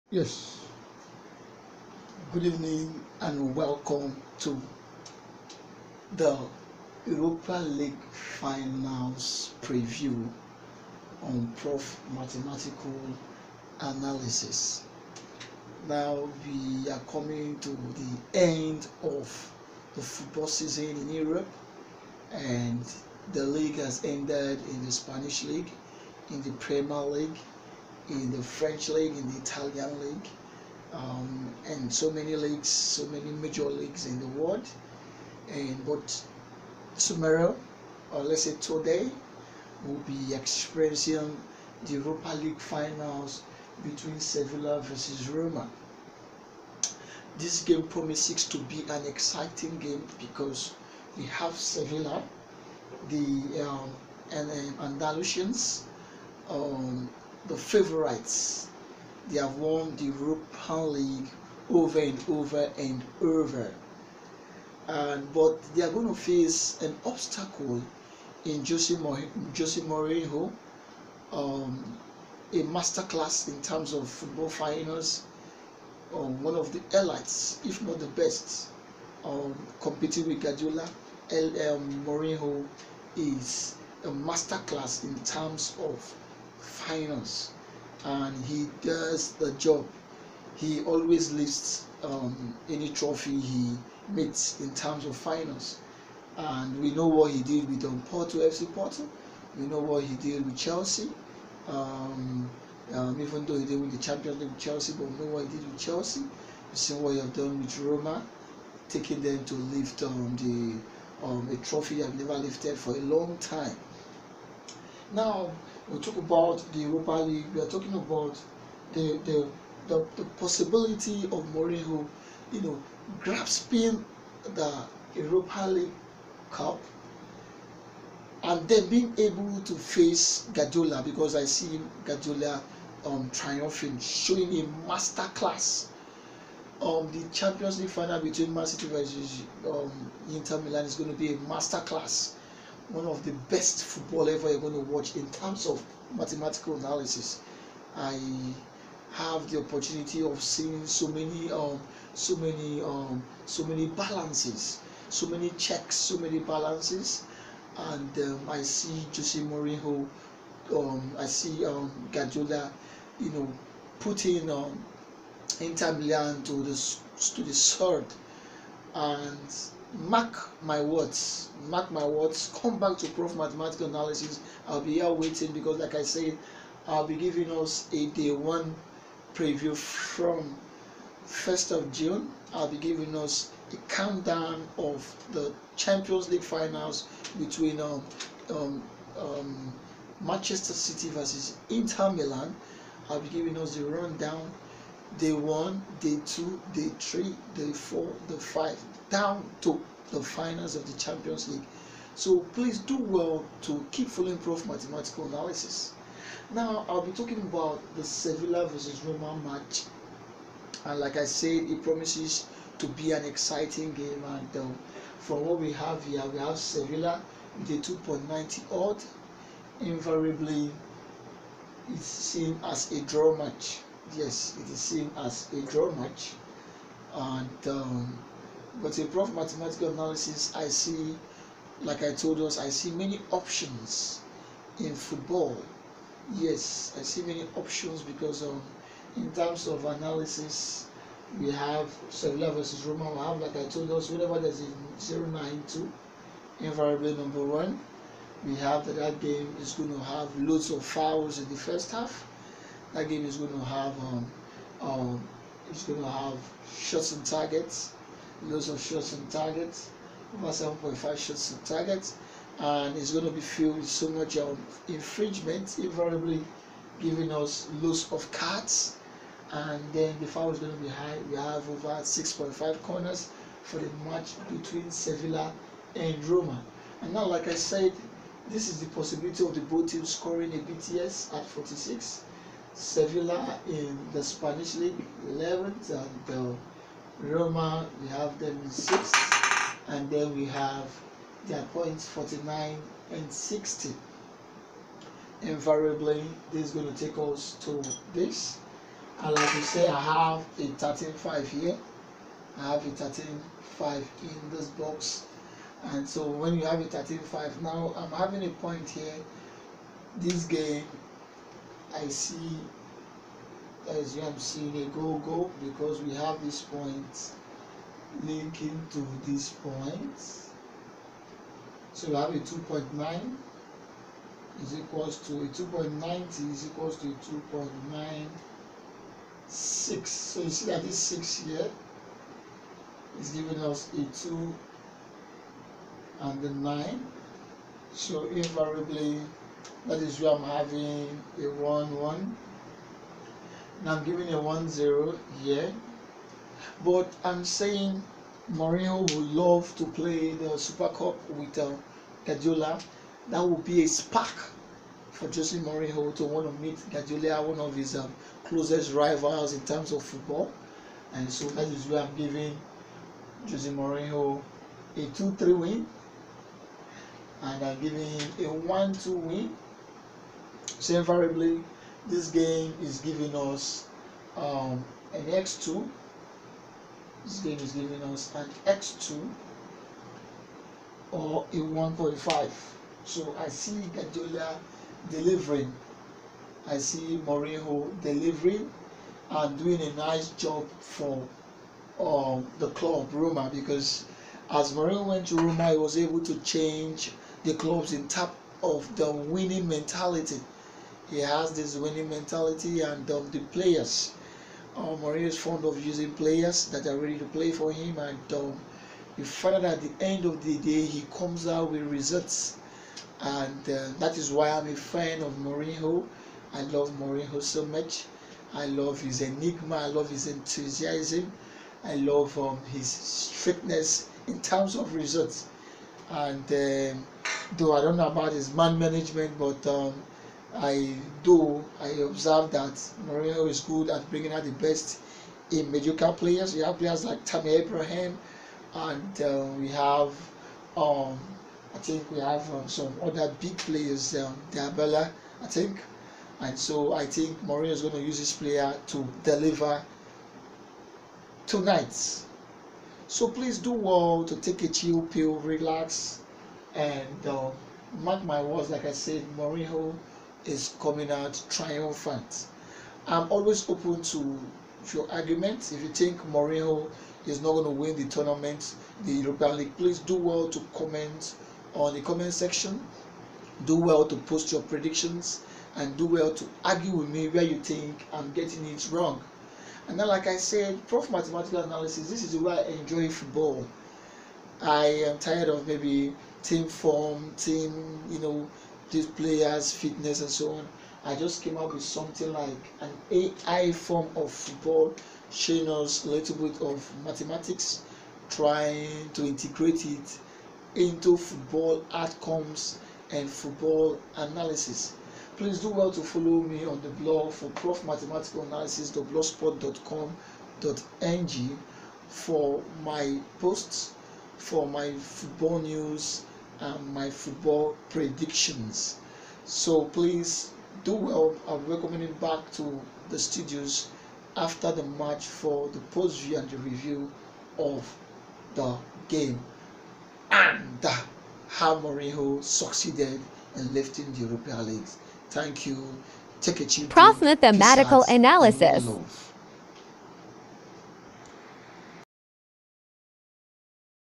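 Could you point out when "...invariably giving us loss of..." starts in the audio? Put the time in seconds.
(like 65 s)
265 s.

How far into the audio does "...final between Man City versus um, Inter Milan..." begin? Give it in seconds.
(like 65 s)
137 s.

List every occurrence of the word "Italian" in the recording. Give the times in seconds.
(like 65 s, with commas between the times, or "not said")
29 s.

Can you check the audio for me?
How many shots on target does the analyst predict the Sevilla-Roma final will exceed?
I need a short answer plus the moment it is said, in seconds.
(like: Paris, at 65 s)
over 7.5, at 260 s.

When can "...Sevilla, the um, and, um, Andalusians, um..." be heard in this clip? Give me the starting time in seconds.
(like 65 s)
51 s.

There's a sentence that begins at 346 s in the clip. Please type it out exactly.
But I'm saying Mourinho would love to play the Super Cup with uh, Guardiola.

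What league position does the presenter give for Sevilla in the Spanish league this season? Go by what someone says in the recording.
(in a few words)
11th.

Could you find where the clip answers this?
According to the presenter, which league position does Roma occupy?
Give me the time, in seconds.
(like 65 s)
288 s.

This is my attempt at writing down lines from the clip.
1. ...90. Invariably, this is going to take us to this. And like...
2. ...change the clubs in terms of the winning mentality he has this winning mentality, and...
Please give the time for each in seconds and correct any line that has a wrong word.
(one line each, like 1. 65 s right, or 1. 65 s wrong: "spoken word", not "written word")
1. 293 s wrong: "60", not "90"
2. 396 s right.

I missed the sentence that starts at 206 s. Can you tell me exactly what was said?
Now I'll be talking about the Sevilla versus Roma match, and like I said, it promises to be an exciting game.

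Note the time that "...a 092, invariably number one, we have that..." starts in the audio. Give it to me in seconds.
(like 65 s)
244 s.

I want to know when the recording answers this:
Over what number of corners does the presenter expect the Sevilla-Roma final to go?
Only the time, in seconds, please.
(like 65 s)
271 s.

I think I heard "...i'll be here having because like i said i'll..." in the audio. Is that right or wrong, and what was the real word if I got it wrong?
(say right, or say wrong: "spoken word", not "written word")
wrong: "waiting", not "having".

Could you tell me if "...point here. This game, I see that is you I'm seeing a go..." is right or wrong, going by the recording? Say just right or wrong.
right.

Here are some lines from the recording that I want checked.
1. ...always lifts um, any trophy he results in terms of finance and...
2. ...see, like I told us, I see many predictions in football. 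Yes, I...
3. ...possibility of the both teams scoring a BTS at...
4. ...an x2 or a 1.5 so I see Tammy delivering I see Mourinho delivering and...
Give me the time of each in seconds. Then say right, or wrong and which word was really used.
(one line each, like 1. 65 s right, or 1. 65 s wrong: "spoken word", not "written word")
1. 90 s wrong: "meets", not "results"
2. 230 s wrong: "options", not "predictions"
3. 278 s right
4. 378 s wrong: "Guardiola", not "Tammy".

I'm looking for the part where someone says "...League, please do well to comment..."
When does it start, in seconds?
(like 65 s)
469 s.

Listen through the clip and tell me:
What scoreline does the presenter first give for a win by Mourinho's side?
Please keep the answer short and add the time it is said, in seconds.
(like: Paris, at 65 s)
2-3, at 364 s.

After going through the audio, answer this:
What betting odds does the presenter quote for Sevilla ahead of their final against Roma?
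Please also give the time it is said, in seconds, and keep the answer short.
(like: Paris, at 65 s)
2.90, at 217 s.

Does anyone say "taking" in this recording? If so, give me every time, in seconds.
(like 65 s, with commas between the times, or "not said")
108 s.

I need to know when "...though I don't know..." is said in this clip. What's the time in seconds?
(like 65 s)
427 s.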